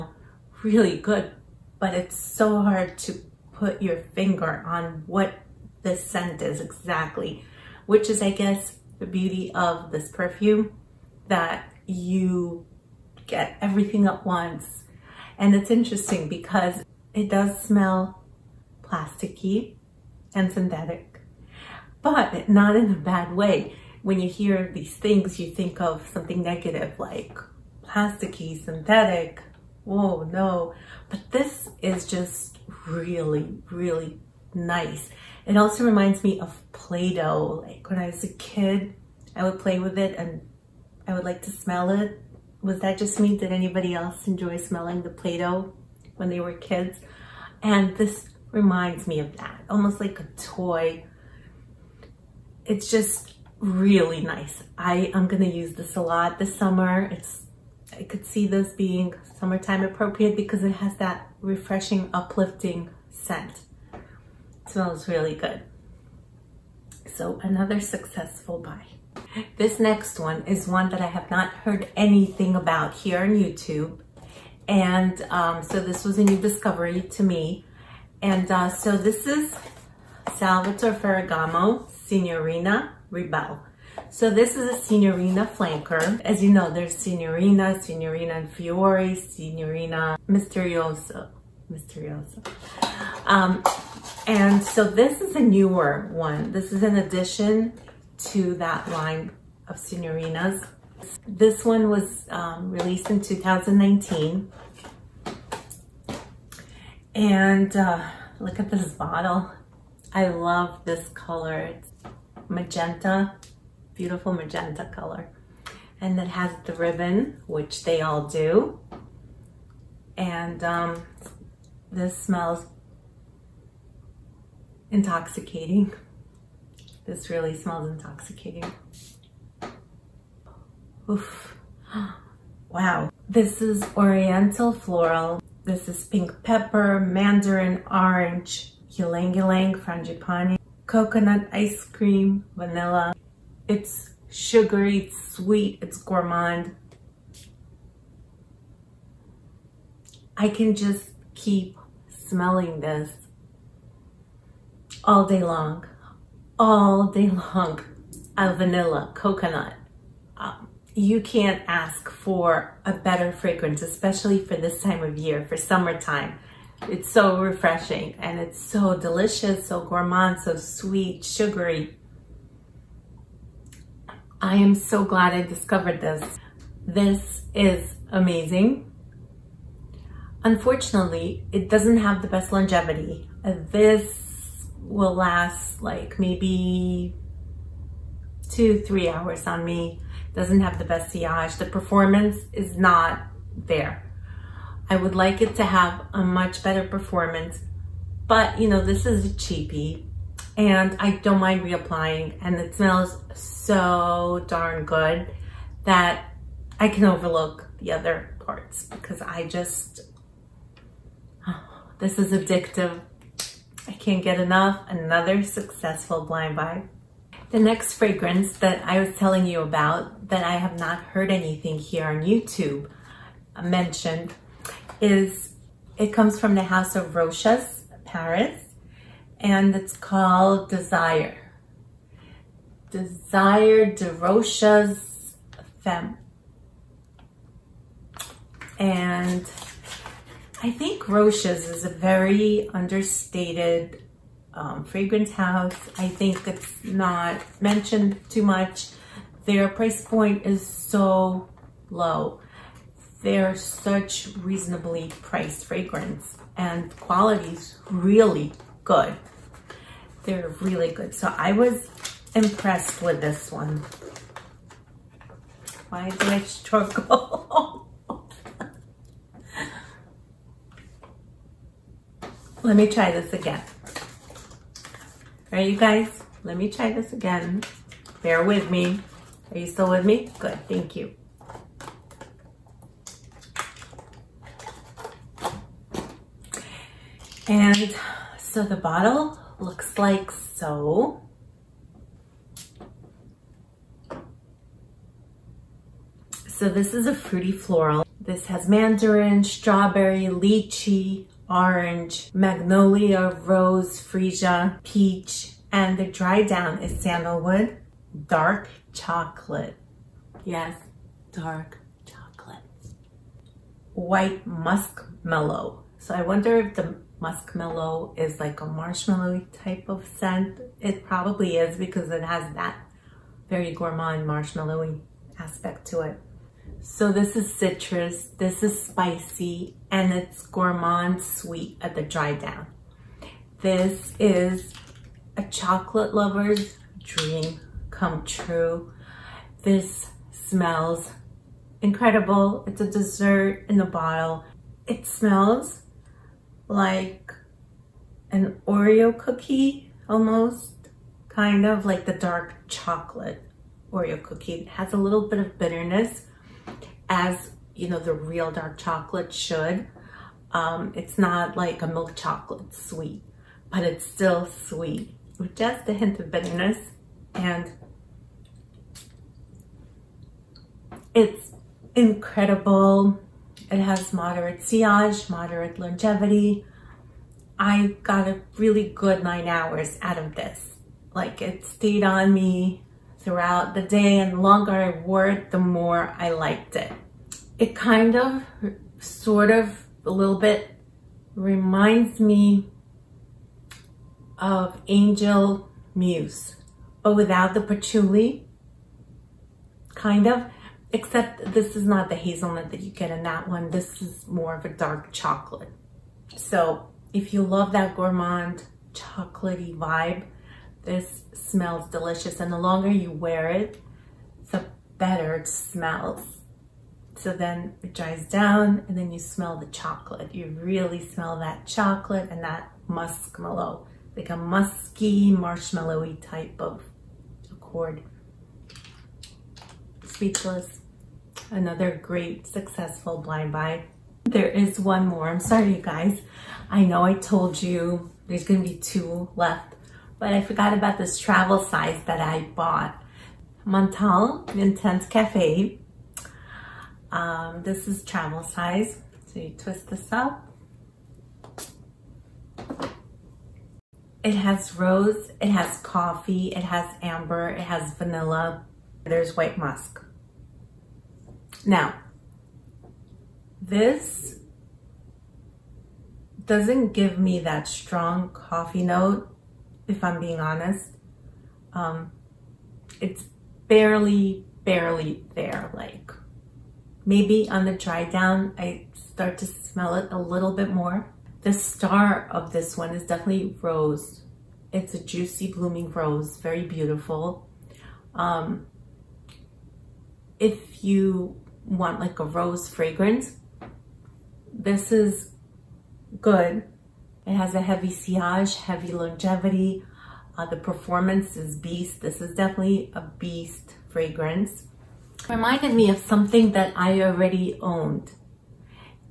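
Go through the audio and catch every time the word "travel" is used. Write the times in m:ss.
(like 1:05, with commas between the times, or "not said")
7:21, 7:28.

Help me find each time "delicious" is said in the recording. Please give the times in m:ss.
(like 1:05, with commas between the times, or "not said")
2:48, 6:51.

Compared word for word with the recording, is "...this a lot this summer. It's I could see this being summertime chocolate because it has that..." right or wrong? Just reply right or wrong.
wrong.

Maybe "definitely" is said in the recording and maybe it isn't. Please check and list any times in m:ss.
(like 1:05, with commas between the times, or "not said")
8:03, 8:22.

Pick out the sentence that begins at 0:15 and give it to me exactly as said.
And it's interesting because it does smell plasticky and synthetic, but not in a bad way.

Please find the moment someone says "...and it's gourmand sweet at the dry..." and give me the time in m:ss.
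5:29.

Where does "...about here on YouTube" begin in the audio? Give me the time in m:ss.
1:12.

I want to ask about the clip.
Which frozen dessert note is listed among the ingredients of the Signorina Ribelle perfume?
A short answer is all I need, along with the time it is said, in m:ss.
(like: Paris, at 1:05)
Coconut Ice Cream, at 2:20.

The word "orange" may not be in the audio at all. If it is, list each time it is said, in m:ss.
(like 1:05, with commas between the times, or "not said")
2:17, 5:01.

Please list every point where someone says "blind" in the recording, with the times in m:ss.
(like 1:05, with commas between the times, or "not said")
3:36, 7:13.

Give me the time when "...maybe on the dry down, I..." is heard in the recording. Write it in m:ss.
7:57.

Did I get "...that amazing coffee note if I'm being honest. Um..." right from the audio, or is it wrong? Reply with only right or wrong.
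wrong.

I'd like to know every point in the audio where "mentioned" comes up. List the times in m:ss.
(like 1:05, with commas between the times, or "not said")
3:43, 4:07.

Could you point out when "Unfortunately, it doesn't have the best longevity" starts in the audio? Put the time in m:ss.
3:00.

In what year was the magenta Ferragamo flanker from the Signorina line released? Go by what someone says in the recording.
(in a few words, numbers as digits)
2019.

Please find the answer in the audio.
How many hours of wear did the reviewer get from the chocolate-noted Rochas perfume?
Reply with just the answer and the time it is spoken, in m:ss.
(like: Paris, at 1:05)
9, at 6:19.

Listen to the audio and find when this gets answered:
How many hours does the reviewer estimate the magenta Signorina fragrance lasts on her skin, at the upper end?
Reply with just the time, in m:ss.
3:08.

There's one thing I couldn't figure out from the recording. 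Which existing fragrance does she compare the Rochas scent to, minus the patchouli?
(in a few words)
Angel Muse.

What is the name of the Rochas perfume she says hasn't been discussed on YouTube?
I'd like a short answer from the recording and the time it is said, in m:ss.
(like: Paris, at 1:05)
Desire de Rochas Femme, at 3:52.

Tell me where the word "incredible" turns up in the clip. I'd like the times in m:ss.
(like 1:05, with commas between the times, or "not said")
5:41, 6:11.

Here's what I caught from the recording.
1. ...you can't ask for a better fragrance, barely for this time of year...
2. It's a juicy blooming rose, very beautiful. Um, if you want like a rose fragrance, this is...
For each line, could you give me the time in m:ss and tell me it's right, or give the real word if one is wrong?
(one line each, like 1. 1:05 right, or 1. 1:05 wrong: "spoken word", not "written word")
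1. 2:40 wrong: "especially", not "barely"
2. 8:04 right.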